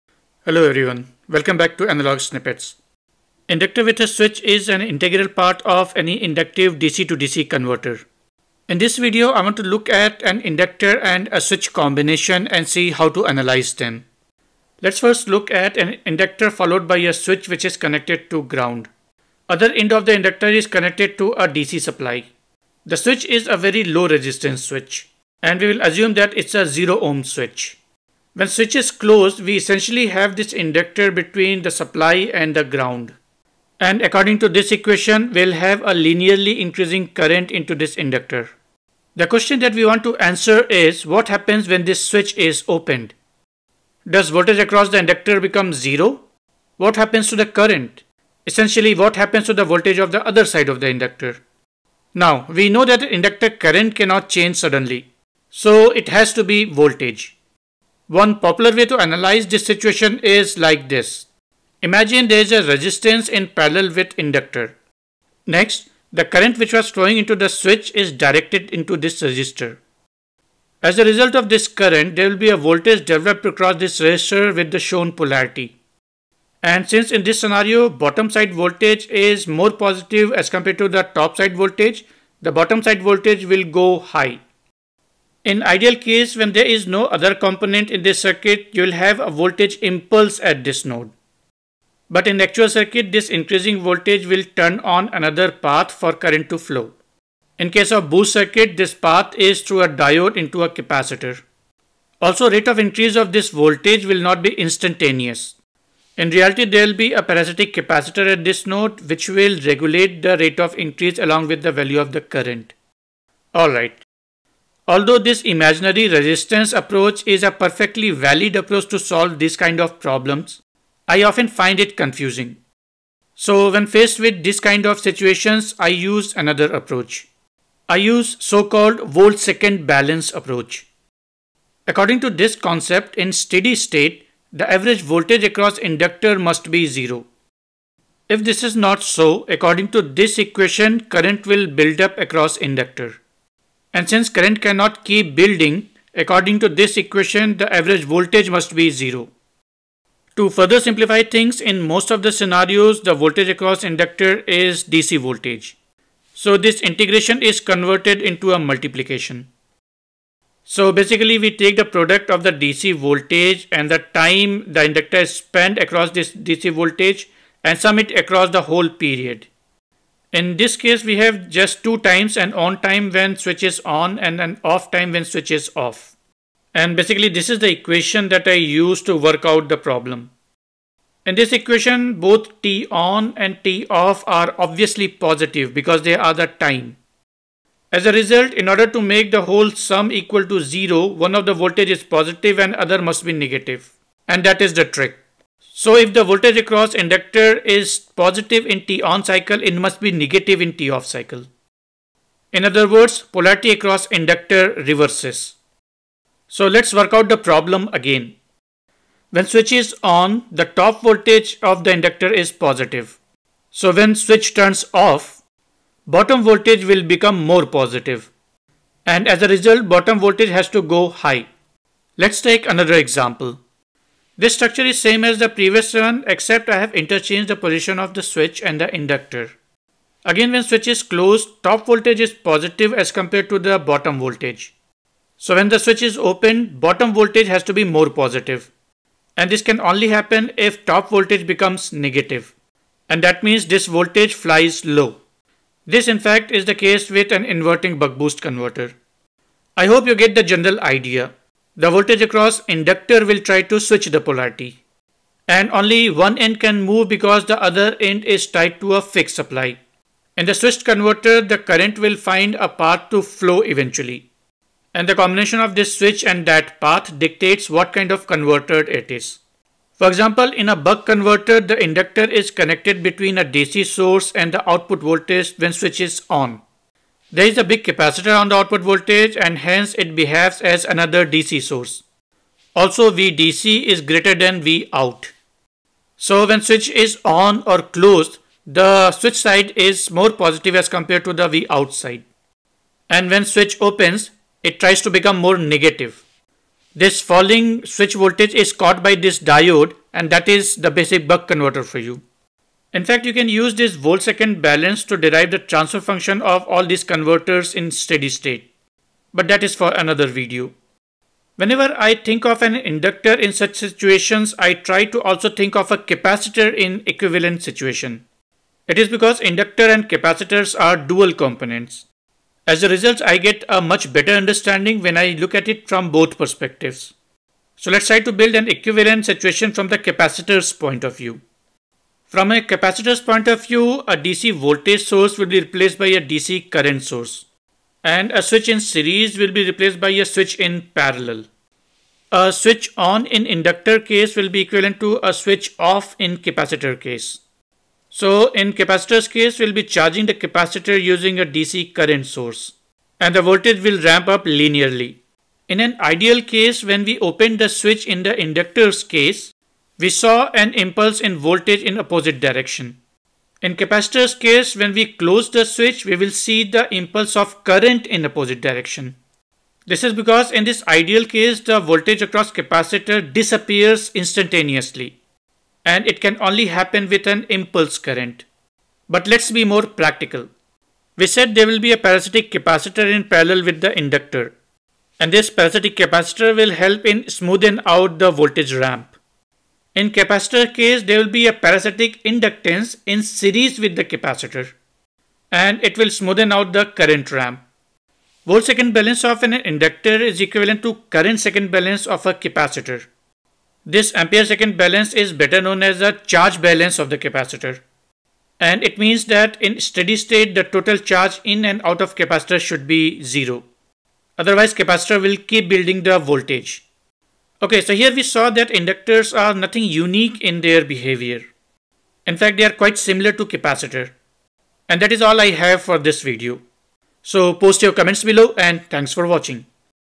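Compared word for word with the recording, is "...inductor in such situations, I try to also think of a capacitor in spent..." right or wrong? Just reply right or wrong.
wrong.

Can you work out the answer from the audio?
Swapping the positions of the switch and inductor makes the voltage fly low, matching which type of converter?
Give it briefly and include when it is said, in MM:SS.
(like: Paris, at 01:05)
Inverting buck boost converter, at 04:07.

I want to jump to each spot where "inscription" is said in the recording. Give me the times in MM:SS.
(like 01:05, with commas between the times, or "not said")
not said.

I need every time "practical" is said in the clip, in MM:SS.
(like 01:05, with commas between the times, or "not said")
06:19.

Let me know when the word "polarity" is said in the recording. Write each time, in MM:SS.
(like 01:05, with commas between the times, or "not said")
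01:15, 03:23, 04:14.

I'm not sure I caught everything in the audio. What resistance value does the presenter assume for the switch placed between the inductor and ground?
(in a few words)
0 ohm.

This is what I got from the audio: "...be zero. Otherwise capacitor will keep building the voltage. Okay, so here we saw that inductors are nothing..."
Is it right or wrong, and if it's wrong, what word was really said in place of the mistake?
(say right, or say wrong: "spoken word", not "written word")
right.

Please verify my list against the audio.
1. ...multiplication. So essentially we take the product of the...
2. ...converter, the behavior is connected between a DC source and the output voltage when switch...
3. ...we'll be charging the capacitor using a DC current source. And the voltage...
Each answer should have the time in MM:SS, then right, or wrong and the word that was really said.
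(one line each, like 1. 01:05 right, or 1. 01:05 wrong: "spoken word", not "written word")
1. 02:38 wrong: "basically", not "essentially"
2. 04:31 wrong: "inductor", not "behavior"
3. 05:49 right.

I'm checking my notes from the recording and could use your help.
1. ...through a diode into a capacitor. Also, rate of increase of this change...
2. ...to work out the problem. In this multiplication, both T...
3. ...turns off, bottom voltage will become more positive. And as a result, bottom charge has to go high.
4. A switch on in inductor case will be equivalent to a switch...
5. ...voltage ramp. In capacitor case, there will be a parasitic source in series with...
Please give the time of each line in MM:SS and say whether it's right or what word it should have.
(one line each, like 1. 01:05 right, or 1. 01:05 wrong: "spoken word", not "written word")
1. 01:39 wrong: "voltage", not "change"
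2. 02:59 wrong: "equation", not "multiplication"
3. 03:34 wrong: "voltage", not "charge"
4. 05:42 right
5. 06:28 wrong: "inductance", not "source".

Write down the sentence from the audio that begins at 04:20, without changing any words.
In the switched converter, the current will find a path to flow eventually.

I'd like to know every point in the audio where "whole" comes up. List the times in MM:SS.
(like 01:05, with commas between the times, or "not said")
02:48, 03:09.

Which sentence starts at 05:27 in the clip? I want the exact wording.
So let's try to build an equivalent situation from the capacitor's point of view.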